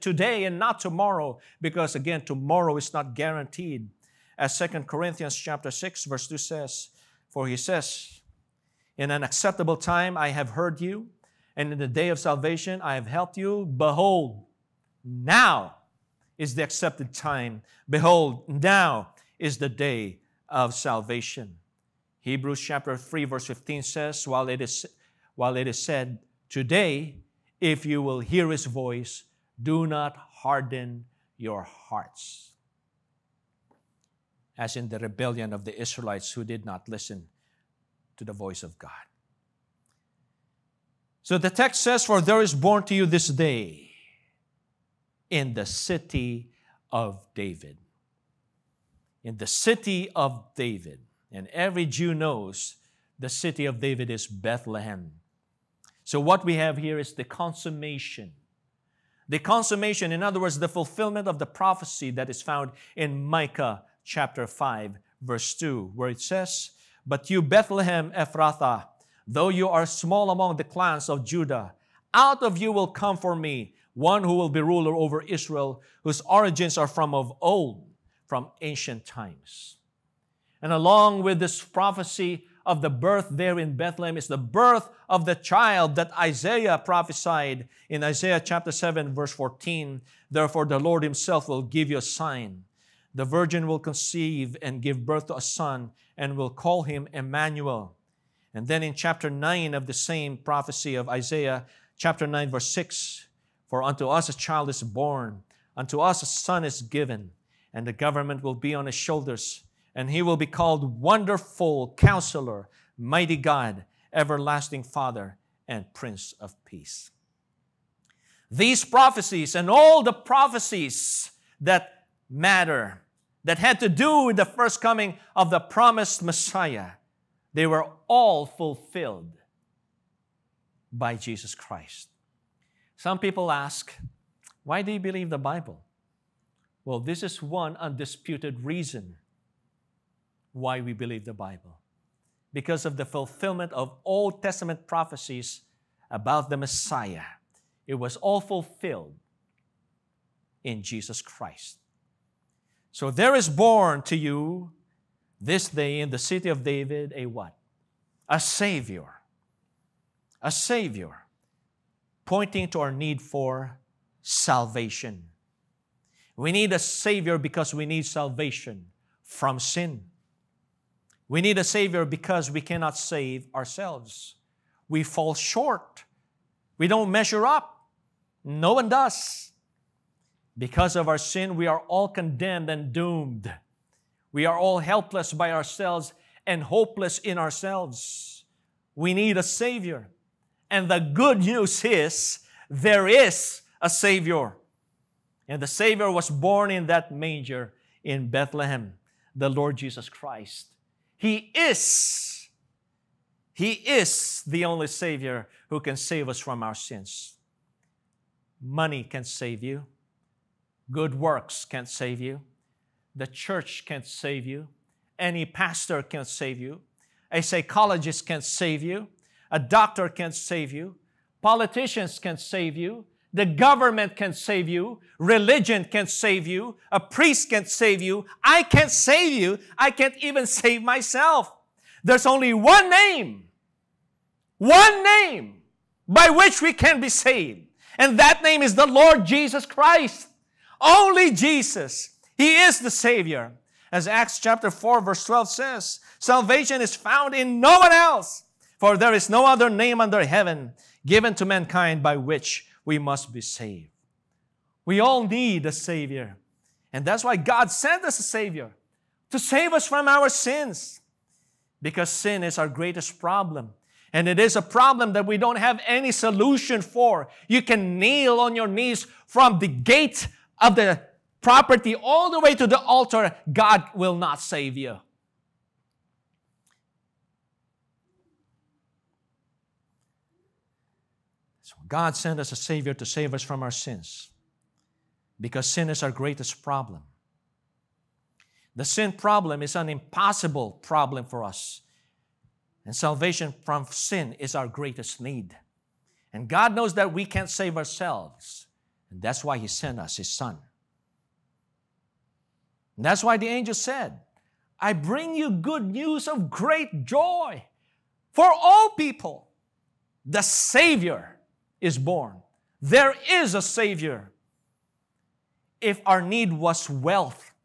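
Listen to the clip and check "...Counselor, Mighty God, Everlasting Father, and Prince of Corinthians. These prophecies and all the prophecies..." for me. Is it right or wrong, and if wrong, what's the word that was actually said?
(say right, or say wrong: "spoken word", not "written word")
wrong: "Peace", not "Corinthians".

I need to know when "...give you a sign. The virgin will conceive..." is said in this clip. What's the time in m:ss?
1:31.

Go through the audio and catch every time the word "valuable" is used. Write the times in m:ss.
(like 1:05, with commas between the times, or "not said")
not said.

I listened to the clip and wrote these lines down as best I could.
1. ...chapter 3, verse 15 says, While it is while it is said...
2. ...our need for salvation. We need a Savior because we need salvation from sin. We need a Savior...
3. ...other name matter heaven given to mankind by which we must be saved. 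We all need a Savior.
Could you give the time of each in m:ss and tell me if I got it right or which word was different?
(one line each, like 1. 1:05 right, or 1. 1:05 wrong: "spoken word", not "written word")
1. 0:22 right
2. 2:42 right
3. 4:09 wrong: "under", not "matter".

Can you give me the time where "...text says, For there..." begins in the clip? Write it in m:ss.
0:41.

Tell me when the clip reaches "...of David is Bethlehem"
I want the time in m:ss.
0:53.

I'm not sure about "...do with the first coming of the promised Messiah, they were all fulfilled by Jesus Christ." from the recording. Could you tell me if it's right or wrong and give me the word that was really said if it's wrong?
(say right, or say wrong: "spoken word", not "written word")
right.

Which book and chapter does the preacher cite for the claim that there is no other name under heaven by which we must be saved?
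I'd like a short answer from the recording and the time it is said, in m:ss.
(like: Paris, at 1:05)
Acts chapter 4, at 4:04.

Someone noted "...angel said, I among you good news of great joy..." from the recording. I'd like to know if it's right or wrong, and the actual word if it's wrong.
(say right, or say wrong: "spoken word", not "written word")
wrong: "bring", not "among".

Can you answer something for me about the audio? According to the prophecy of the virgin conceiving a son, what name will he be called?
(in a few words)
Emmanuel.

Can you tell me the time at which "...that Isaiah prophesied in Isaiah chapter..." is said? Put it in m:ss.
1:25.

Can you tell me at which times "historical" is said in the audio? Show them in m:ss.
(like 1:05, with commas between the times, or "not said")
not said.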